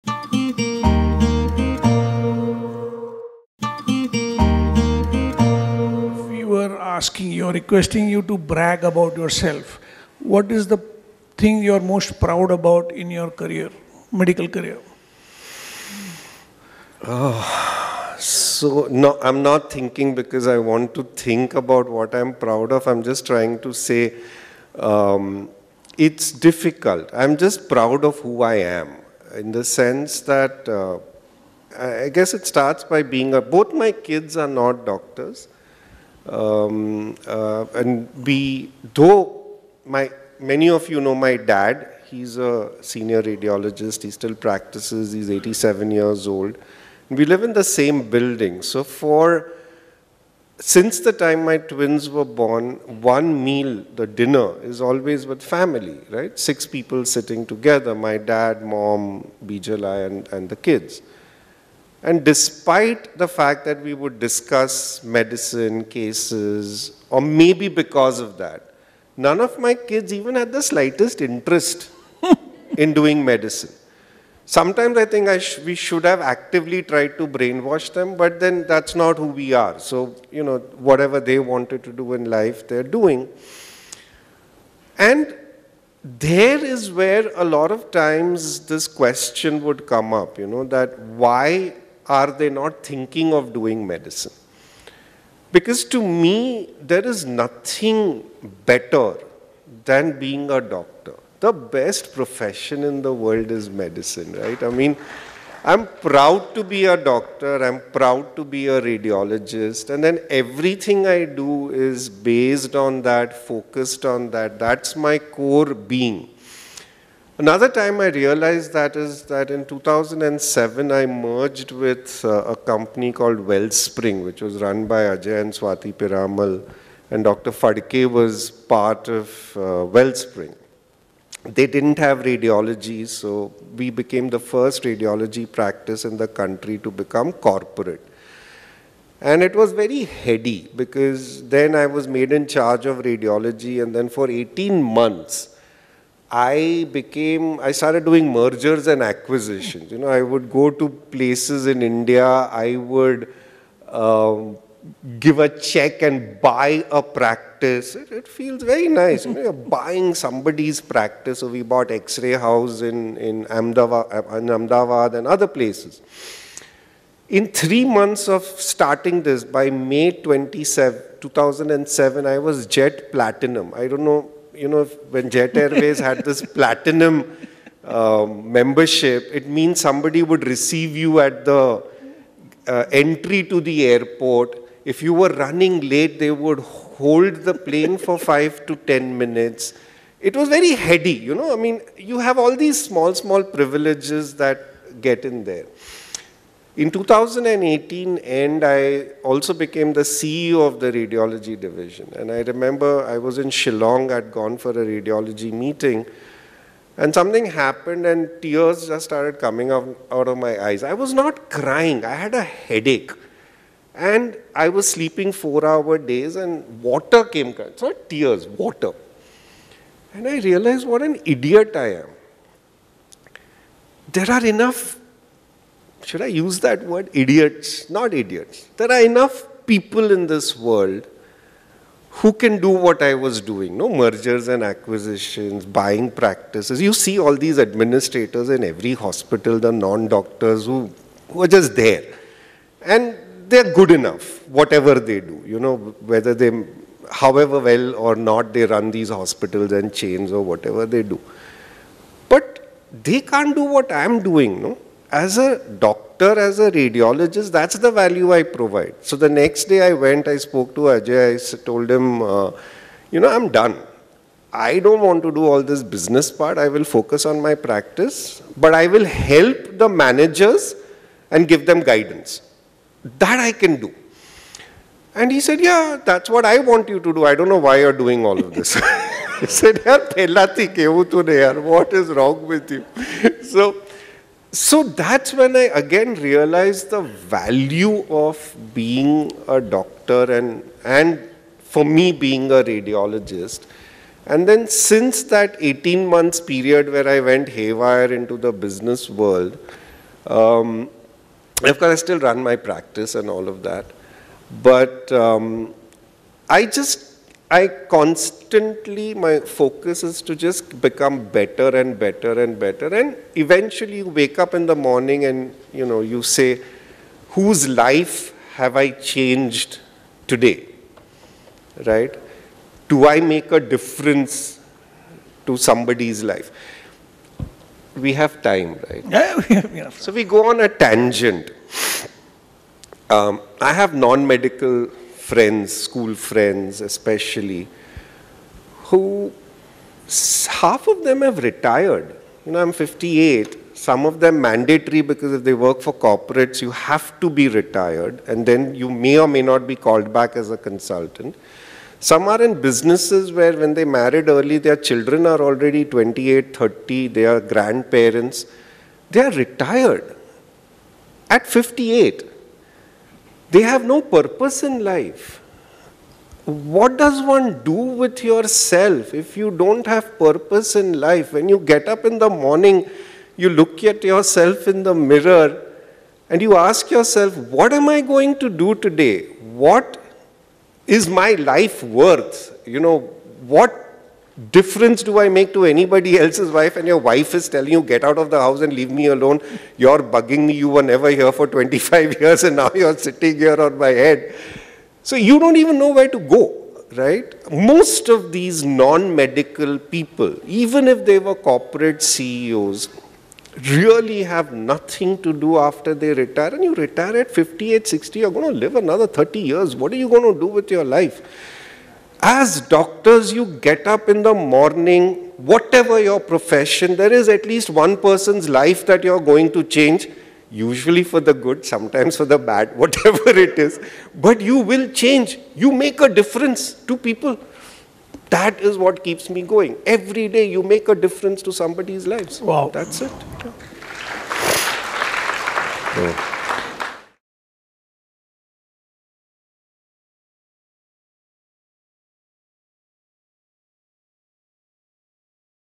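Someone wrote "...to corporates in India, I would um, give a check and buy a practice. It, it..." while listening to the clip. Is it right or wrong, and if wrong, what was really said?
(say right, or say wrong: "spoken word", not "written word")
wrong: "places", not "corporates".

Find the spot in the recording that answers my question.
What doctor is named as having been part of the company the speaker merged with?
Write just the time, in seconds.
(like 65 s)
127 s.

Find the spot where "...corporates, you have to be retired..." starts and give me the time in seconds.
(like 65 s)
345 s.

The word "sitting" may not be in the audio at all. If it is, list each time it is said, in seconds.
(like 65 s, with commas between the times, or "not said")
57 s, 392 s.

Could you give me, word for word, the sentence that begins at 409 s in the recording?
What are you going to do with your life?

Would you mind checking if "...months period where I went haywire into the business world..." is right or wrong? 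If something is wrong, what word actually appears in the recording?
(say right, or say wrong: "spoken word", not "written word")
right.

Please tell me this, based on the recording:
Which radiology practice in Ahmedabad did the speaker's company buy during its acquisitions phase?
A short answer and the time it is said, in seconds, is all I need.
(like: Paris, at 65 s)
X-Ray House, at 161 s.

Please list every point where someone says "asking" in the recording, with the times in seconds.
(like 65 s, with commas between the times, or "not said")
7 s.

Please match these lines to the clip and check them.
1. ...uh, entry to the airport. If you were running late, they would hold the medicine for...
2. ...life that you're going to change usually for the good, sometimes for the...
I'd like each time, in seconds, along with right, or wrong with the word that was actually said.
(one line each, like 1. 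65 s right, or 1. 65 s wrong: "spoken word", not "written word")
1. 182 s wrong: "plane", not "medicine"
2. 418 s right.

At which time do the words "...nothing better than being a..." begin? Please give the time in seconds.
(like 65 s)
97 s.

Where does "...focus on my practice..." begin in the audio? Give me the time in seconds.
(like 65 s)
266 s.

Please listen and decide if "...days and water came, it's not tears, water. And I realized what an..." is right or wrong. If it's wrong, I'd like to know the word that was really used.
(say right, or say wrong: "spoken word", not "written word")
right.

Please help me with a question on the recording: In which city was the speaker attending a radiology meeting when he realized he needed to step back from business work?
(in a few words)
Shillong.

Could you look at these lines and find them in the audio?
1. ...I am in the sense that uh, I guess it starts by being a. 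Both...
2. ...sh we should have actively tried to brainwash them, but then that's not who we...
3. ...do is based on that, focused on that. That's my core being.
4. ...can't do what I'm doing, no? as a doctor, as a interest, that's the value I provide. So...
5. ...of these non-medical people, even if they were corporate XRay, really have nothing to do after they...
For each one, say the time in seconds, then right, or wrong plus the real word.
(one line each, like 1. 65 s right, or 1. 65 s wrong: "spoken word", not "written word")
1. 28 s right
2. 75 s right
3. 111 s right
4. 253 s wrong: "radiologist", not "interest"
5. 398 s wrong: "CEOs", not "XRay".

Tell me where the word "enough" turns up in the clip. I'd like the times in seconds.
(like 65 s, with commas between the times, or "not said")
224 s, 229 s, 243 s, 329 s.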